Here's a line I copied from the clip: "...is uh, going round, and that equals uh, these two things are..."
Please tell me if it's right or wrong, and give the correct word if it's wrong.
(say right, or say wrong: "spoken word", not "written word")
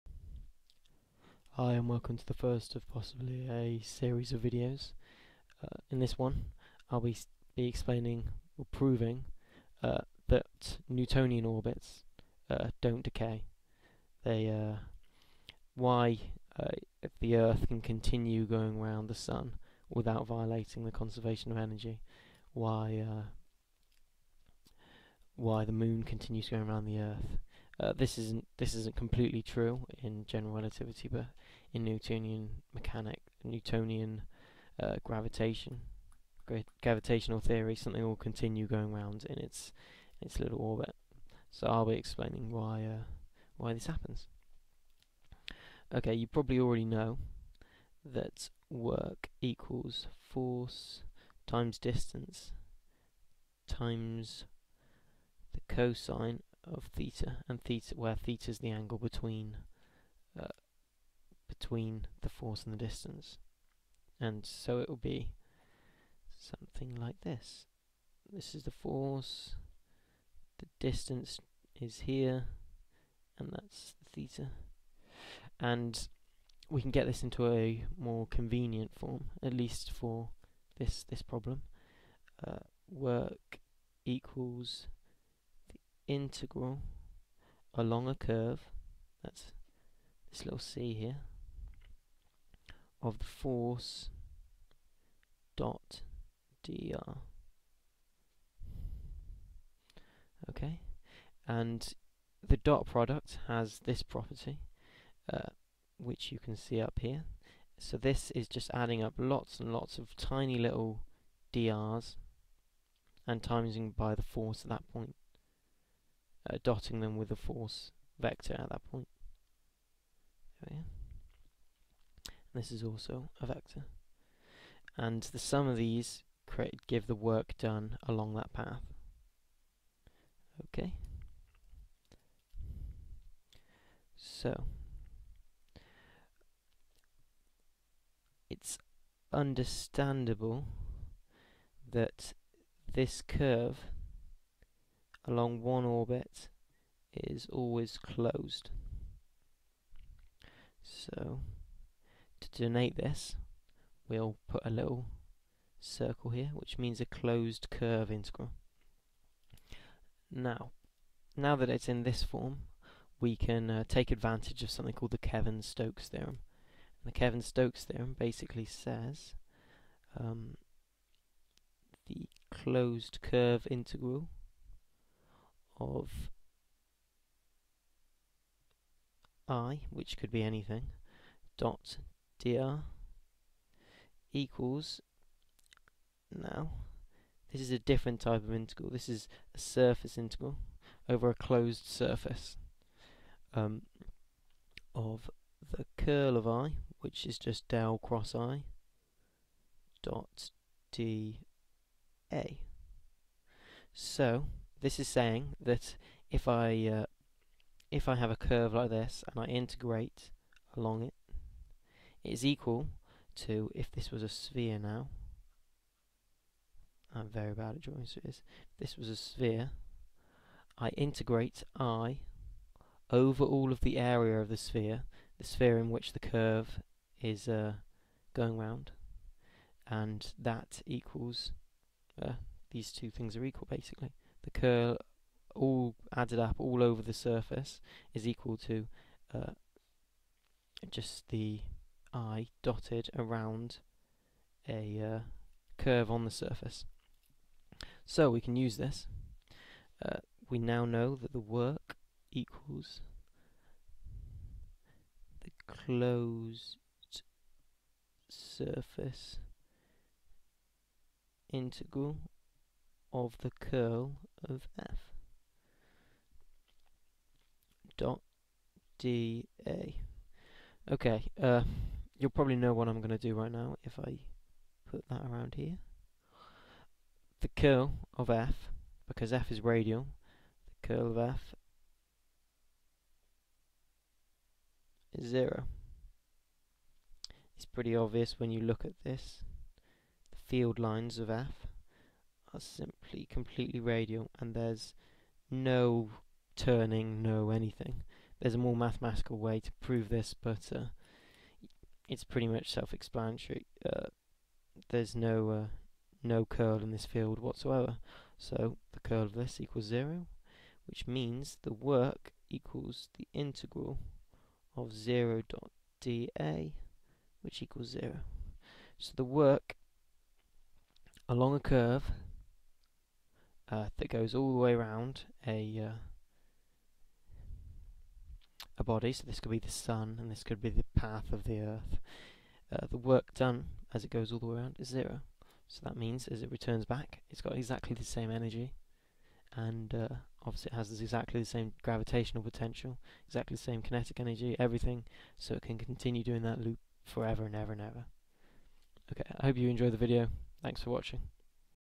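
right.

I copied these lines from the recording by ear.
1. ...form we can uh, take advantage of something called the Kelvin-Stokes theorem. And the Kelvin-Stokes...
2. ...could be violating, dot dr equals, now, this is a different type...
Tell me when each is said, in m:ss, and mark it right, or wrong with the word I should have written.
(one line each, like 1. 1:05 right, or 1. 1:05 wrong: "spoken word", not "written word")
1. 2:42 right
2. 3:00 wrong: "anything", not "violating".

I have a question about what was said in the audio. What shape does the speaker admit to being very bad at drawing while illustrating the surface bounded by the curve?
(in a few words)
spheres.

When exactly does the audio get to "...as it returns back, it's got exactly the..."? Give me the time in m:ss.
5:36.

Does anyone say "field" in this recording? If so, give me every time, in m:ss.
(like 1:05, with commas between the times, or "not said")
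4:50, 5:07.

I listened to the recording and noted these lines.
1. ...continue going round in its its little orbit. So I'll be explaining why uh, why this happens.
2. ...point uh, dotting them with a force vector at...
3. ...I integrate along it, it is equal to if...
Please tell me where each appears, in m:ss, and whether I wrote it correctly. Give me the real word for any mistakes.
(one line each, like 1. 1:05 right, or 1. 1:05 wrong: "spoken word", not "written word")
1. 0:38 right
2. 1:54 right
3. 3:29 right.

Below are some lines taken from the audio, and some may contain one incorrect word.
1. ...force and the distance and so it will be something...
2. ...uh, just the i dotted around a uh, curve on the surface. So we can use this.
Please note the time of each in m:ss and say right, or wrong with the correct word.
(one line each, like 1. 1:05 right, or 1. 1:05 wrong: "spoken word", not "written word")
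1. 1:02 right
2. 3:59 right.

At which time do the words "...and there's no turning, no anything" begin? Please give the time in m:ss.
4:54.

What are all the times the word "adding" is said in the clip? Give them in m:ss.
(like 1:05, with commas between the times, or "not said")
1:48.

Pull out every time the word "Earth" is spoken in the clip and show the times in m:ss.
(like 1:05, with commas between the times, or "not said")
0:17, 0:27, 5:31.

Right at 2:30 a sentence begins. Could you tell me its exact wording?
So to denote this we'll put a little circle here which means a closed curve integral.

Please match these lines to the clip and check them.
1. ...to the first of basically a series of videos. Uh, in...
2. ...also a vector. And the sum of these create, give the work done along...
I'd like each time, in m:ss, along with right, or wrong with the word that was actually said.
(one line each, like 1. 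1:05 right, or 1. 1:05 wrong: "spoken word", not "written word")
1. 0:02 wrong: "possibly", not "basically"
2. 2:02 right.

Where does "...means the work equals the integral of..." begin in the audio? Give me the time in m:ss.
5:11.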